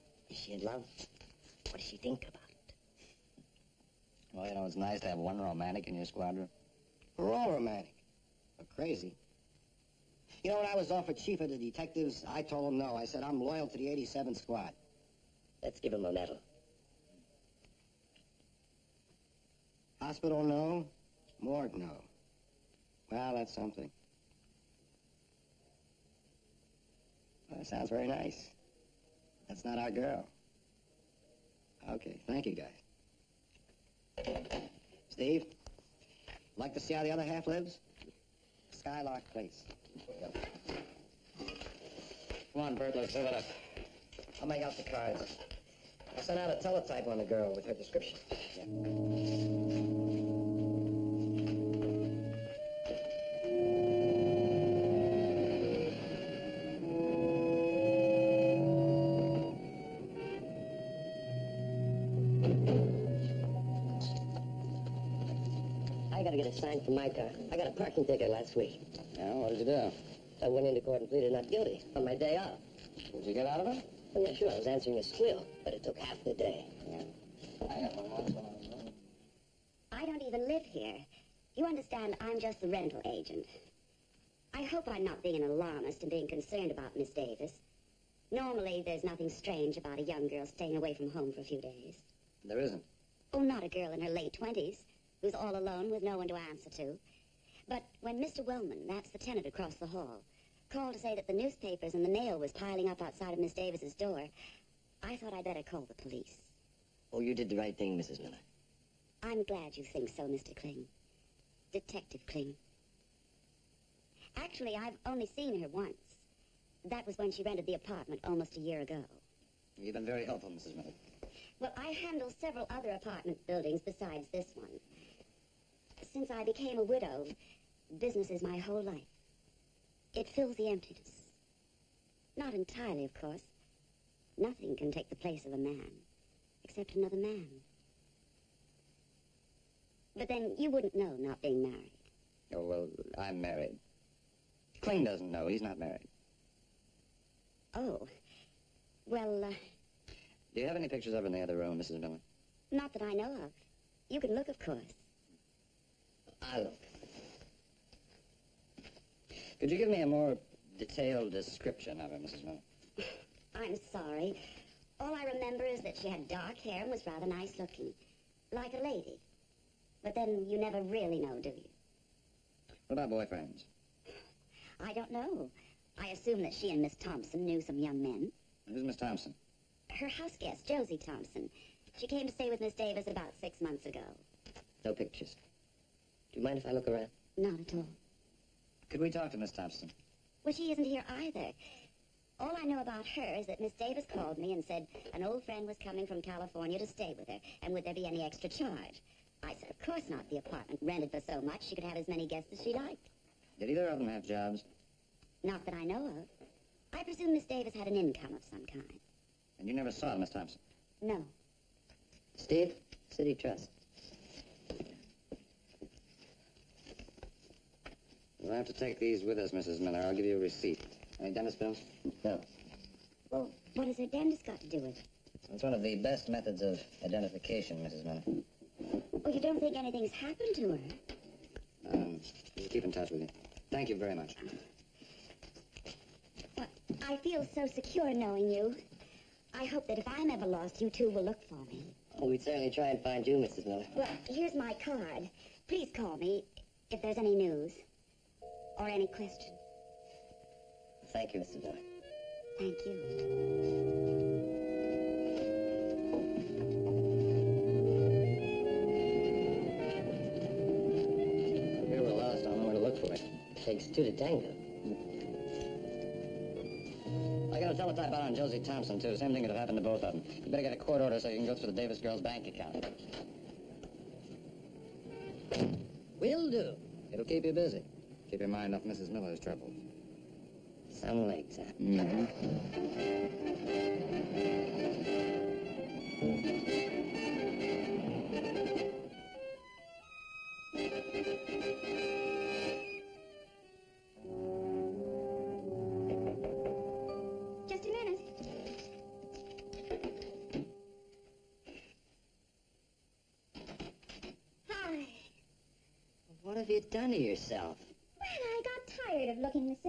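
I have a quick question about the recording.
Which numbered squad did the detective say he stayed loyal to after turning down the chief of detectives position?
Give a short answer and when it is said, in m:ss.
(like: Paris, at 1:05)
87th squad, at 0:13.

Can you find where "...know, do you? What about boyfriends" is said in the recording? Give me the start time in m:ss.
2:51.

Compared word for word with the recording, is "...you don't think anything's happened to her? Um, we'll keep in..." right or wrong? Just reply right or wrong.
right.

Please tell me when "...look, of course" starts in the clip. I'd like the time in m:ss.
2:34.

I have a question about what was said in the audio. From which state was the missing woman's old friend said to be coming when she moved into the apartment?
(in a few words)
California.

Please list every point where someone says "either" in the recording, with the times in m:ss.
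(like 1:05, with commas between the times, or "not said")
3:11, 3:23.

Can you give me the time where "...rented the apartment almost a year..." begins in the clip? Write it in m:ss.
1:57.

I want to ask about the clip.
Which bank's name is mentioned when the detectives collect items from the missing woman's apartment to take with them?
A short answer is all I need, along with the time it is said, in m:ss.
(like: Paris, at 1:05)
City Trust, at 3:33.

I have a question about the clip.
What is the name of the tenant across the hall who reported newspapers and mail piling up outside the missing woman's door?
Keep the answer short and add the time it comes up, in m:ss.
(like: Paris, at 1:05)
Mr. Wellman, at 1:38.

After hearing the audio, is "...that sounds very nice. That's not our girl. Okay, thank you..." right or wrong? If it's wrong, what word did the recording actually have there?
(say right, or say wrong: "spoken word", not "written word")
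right.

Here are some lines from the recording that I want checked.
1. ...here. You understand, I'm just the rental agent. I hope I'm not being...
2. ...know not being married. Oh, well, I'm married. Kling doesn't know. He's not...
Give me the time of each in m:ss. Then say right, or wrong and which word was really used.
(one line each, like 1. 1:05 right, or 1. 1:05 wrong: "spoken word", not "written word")
1. 1:20 right
2. 2:20 right.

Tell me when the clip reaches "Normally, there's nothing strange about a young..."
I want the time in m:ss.
1:28.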